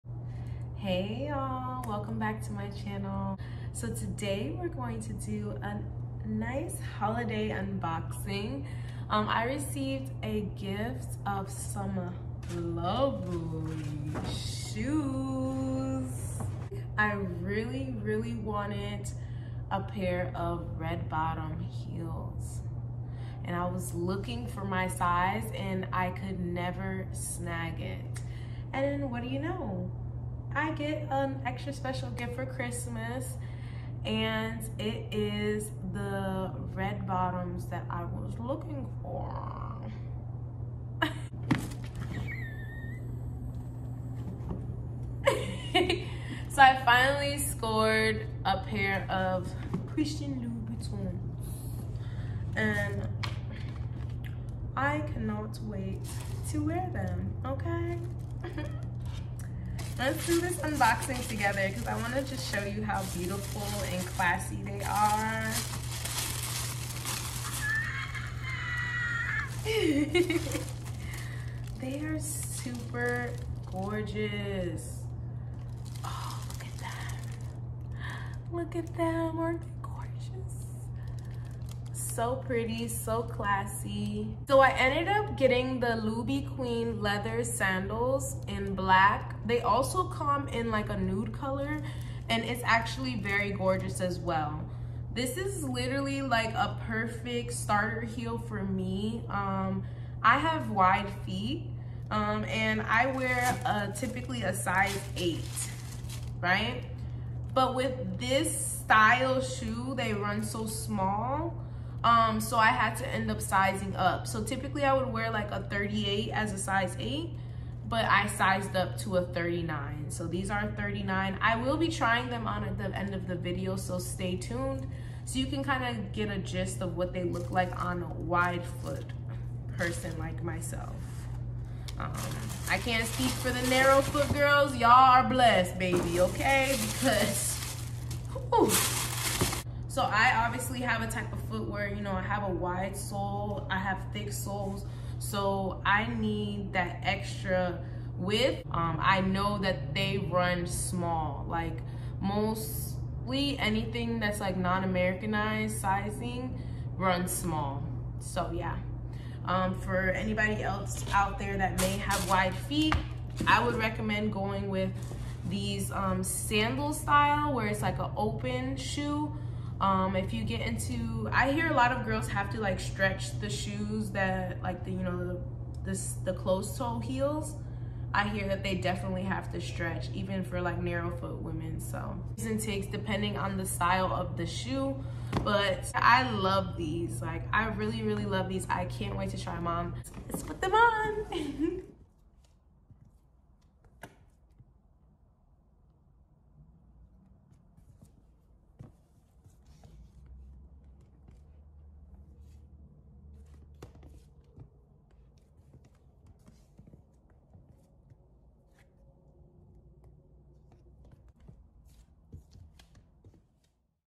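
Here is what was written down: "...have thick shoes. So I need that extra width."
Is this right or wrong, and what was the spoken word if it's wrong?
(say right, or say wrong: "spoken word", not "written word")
wrong: "soles", not "shoes".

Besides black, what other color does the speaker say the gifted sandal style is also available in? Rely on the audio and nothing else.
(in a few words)
Nude.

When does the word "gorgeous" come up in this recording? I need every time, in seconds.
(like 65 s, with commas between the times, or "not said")
73 s, 93 s.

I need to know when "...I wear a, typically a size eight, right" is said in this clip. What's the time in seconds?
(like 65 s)
102 s.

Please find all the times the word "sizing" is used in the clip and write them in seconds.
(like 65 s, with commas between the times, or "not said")
113 s, 155 s.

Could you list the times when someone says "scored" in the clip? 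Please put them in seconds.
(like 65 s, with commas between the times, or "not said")
47 s.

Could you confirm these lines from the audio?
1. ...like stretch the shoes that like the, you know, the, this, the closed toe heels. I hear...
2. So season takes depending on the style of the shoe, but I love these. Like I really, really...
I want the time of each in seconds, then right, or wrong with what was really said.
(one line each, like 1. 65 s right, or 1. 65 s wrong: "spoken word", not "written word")
1. 172 s right
2. 181 s right.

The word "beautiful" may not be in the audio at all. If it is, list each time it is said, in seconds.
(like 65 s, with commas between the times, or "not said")
63 s.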